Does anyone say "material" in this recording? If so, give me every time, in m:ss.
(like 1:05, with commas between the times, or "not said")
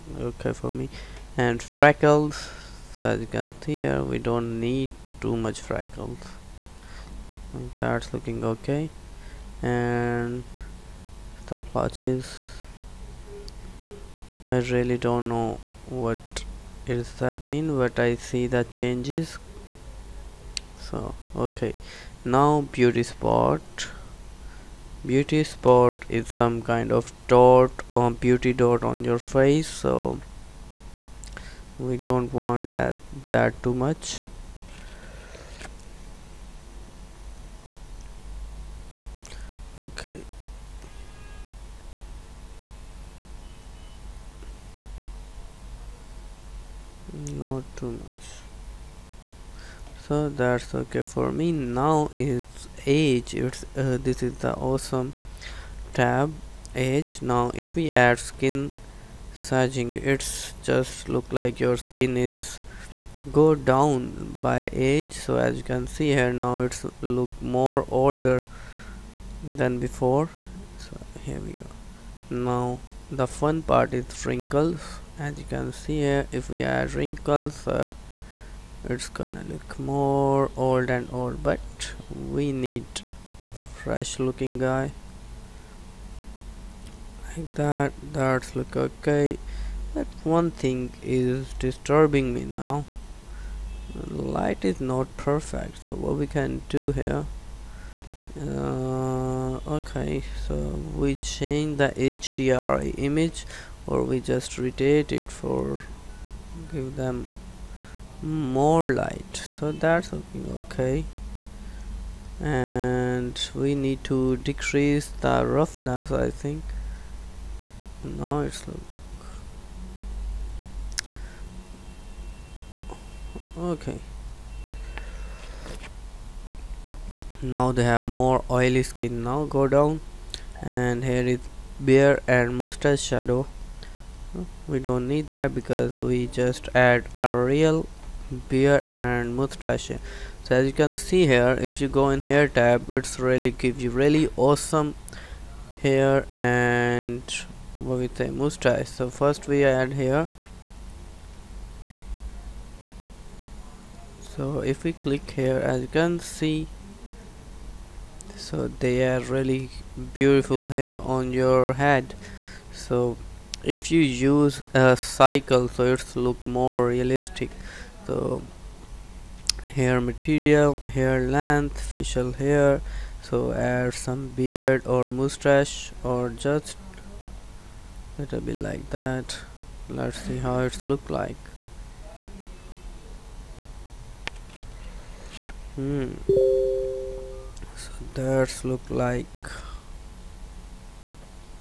2:49.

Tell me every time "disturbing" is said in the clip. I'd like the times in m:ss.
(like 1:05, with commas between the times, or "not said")
1:31.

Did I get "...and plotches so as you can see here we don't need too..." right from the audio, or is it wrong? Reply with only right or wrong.
wrong.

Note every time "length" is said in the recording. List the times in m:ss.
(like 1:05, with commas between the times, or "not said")
2:51.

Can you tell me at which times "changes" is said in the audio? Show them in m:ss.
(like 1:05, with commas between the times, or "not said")
0:18, 1:41.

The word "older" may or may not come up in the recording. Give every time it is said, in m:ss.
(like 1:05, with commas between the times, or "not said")
1:07.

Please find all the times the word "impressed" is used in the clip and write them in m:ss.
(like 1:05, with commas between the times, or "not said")
not said.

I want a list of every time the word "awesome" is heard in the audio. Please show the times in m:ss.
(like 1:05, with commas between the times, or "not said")
0:54, 2:24.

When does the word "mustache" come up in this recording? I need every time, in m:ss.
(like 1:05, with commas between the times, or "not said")
2:12, 2:19, 2:28, 2:55.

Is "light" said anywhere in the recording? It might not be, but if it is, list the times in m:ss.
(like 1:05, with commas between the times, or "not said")
1:34, 1:48.